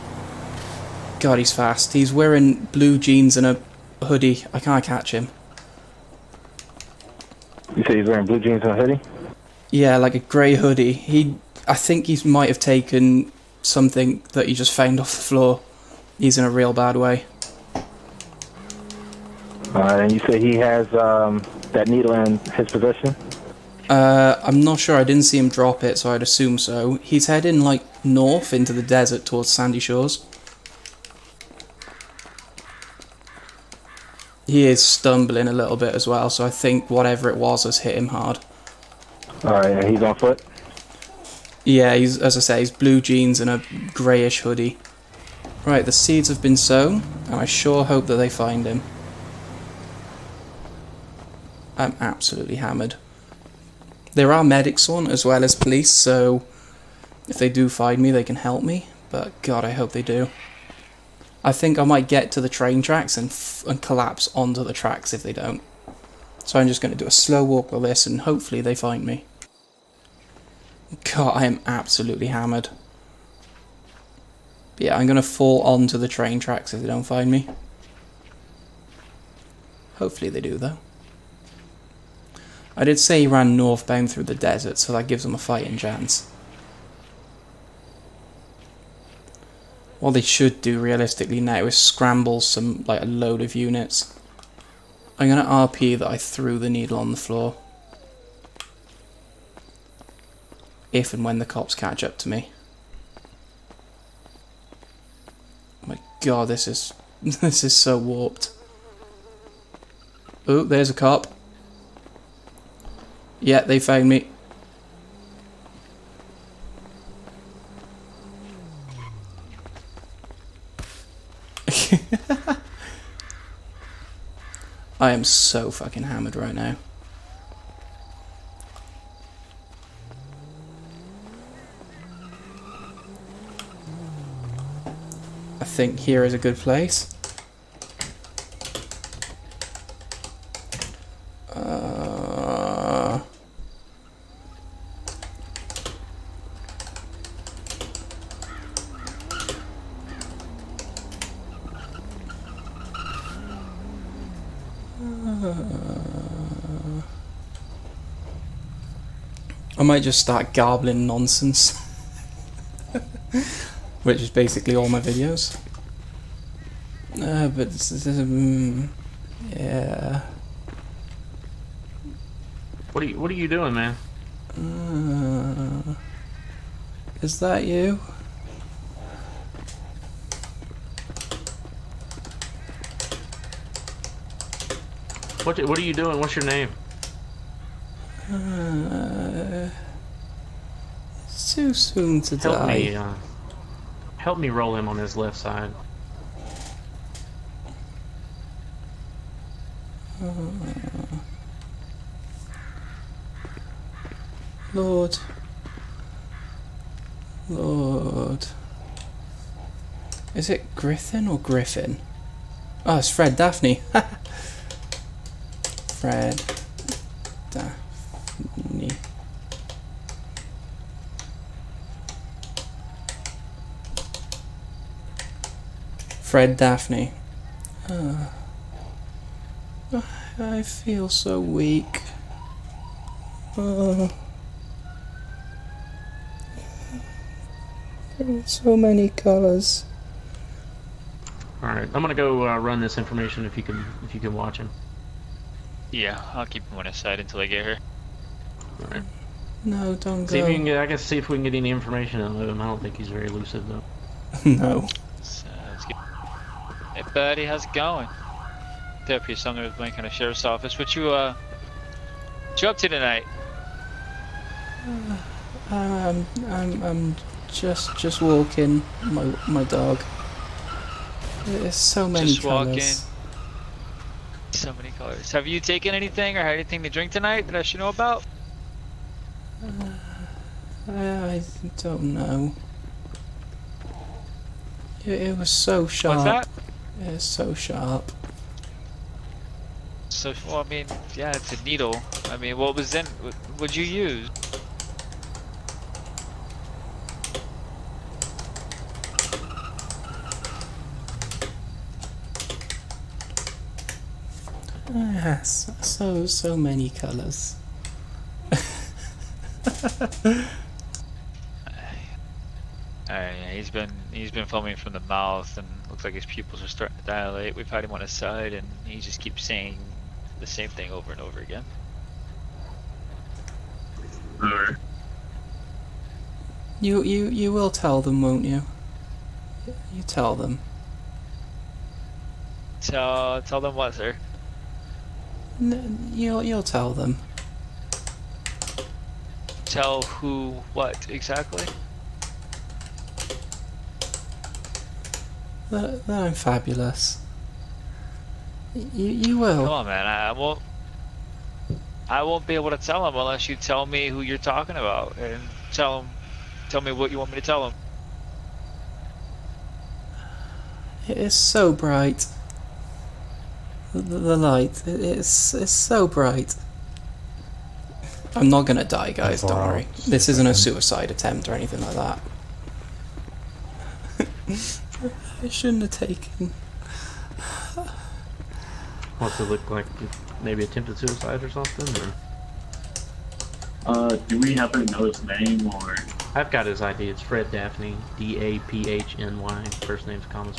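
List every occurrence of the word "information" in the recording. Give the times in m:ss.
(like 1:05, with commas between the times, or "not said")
4:02, 4:11.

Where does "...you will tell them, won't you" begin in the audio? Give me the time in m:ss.
5:27.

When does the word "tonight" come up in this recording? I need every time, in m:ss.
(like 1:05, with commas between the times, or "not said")
4:22, 4:37.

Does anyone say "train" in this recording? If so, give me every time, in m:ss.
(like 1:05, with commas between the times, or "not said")
1:02, 1:16.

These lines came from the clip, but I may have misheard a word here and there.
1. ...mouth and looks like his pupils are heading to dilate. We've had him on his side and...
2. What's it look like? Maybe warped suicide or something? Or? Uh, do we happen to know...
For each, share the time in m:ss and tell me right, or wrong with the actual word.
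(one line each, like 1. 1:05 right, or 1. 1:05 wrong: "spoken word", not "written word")
1. 5:14 wrong: "starting", not "heading"
2. 6:19 wrong: "attempted", not "warped".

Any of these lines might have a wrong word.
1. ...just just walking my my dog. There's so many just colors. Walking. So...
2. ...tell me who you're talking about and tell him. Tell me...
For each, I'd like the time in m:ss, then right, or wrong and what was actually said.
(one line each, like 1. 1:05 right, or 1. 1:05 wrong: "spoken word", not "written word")
1. 4:27 right
2. 5:53 right.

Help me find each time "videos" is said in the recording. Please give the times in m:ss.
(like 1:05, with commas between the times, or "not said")
2:45.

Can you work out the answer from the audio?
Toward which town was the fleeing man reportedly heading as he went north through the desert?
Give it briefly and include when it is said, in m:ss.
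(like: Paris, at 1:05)
Sandy Shores, at 0:29.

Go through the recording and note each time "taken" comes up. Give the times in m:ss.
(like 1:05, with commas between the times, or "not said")
0:12, 4:35, 6:15.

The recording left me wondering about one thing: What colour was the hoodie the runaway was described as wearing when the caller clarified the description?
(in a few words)
grey.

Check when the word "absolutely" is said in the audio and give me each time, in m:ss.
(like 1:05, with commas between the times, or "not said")
0:51, 1:11.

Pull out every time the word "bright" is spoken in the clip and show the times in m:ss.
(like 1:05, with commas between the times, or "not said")
6:01, 6:06.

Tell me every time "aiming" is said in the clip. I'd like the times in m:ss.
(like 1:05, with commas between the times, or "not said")
not said.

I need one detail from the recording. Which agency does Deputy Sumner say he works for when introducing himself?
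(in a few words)
Blaine County Sheriff's Office.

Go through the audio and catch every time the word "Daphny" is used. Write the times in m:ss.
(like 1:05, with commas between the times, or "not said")
3:33, 3:37, 3:46, 6:27.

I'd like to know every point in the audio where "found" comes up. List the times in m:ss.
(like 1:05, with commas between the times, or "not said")
0:14, 1:53.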